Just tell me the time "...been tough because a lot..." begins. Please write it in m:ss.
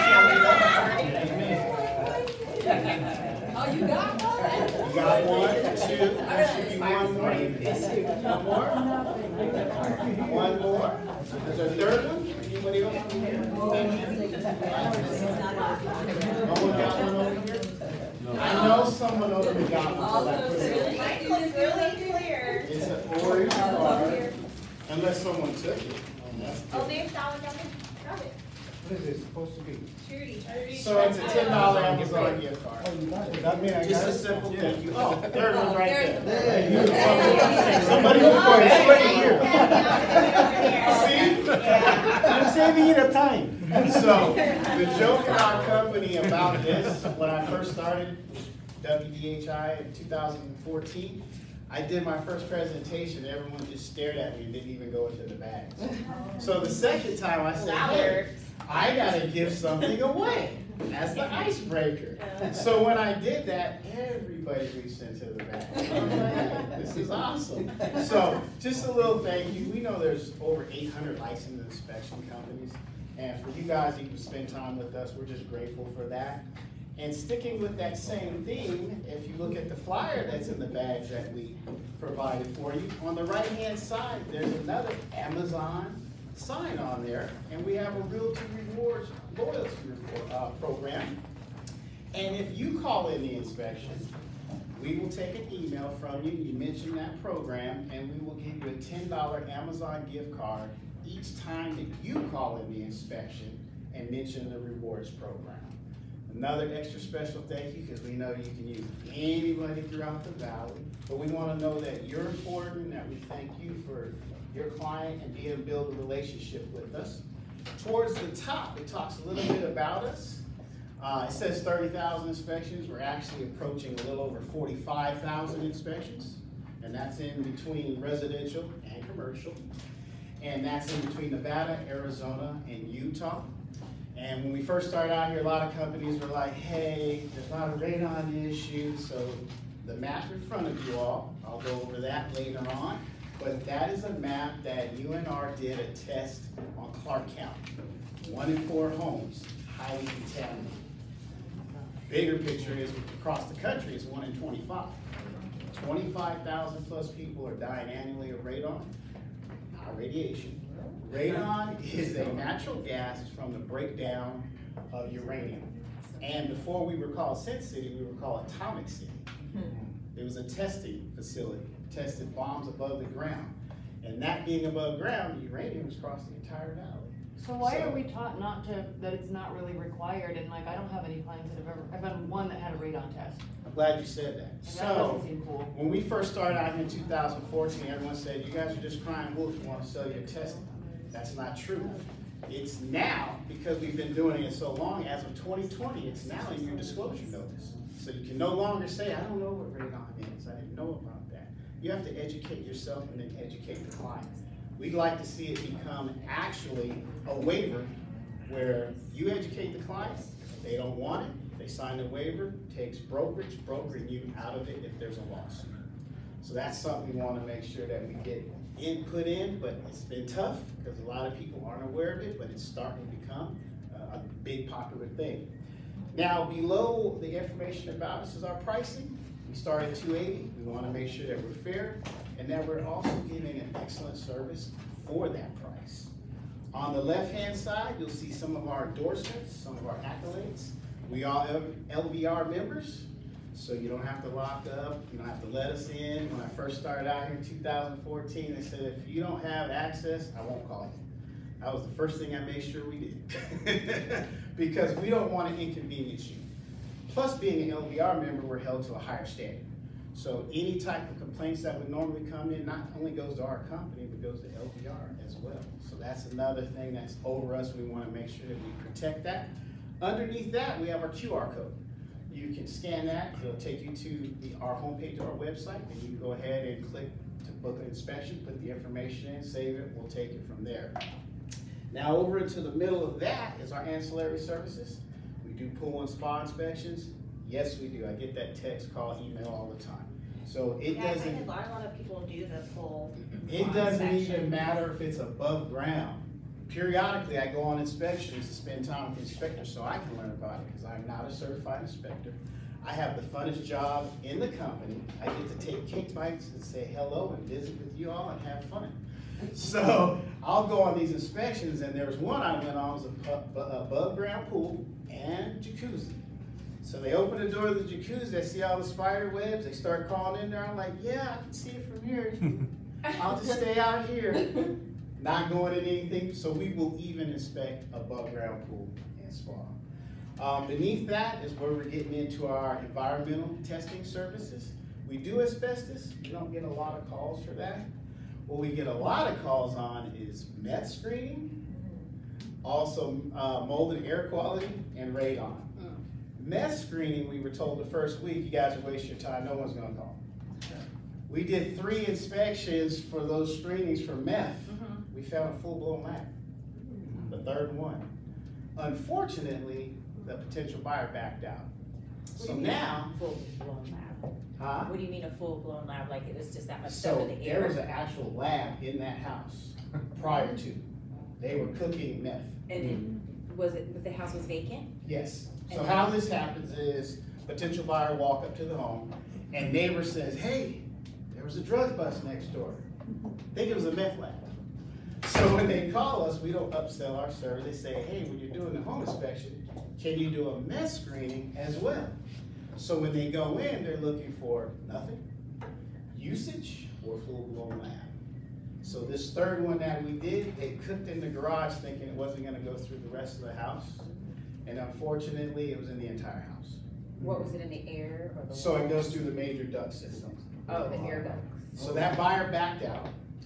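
3:39.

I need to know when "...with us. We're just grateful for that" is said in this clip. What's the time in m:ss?
1:14.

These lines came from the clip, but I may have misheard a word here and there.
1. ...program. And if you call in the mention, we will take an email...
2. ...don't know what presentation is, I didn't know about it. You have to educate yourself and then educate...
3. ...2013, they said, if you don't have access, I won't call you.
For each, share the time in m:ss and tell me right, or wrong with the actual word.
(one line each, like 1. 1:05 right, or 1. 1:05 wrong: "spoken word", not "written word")
1. 1:30 wrong: "inspection", not "mention"
2. 3:19 wrong: "radon", not "presentation"
3. 4:07 wrong: "2014", not "2013".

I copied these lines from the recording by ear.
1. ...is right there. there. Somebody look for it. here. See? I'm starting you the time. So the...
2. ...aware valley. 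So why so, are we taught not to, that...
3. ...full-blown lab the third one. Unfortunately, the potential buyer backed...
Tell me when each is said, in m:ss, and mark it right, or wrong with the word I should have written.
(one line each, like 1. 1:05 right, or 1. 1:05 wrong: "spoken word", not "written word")
1. 0:35 wrong: "saving", not "starting"
2. 2:56 wrong: "entire", not "aware"
3. 5:55 right.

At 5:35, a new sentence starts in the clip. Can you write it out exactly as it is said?
We do asbestos, we don't get a lot of calls for that.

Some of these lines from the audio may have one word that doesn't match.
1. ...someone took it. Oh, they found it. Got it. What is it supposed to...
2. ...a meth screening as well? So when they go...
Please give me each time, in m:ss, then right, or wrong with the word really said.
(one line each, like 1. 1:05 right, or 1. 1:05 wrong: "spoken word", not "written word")
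1. 0:25 right
2. 6:30 right.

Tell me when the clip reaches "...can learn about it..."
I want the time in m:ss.
4:59.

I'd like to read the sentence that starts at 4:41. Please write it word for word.
Now over into the middle of that is our ancillary services do pool and spa inspections?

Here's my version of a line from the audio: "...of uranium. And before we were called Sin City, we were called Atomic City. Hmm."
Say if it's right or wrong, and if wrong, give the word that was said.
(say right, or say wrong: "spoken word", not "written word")
right.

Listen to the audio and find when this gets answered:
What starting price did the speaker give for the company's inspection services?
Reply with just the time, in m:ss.
3:49.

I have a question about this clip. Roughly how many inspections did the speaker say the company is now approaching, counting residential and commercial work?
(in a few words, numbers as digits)
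45,000.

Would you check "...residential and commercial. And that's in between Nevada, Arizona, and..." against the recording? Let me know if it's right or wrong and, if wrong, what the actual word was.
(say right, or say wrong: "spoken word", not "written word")
right.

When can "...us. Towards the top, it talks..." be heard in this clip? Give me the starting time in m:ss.
1:56.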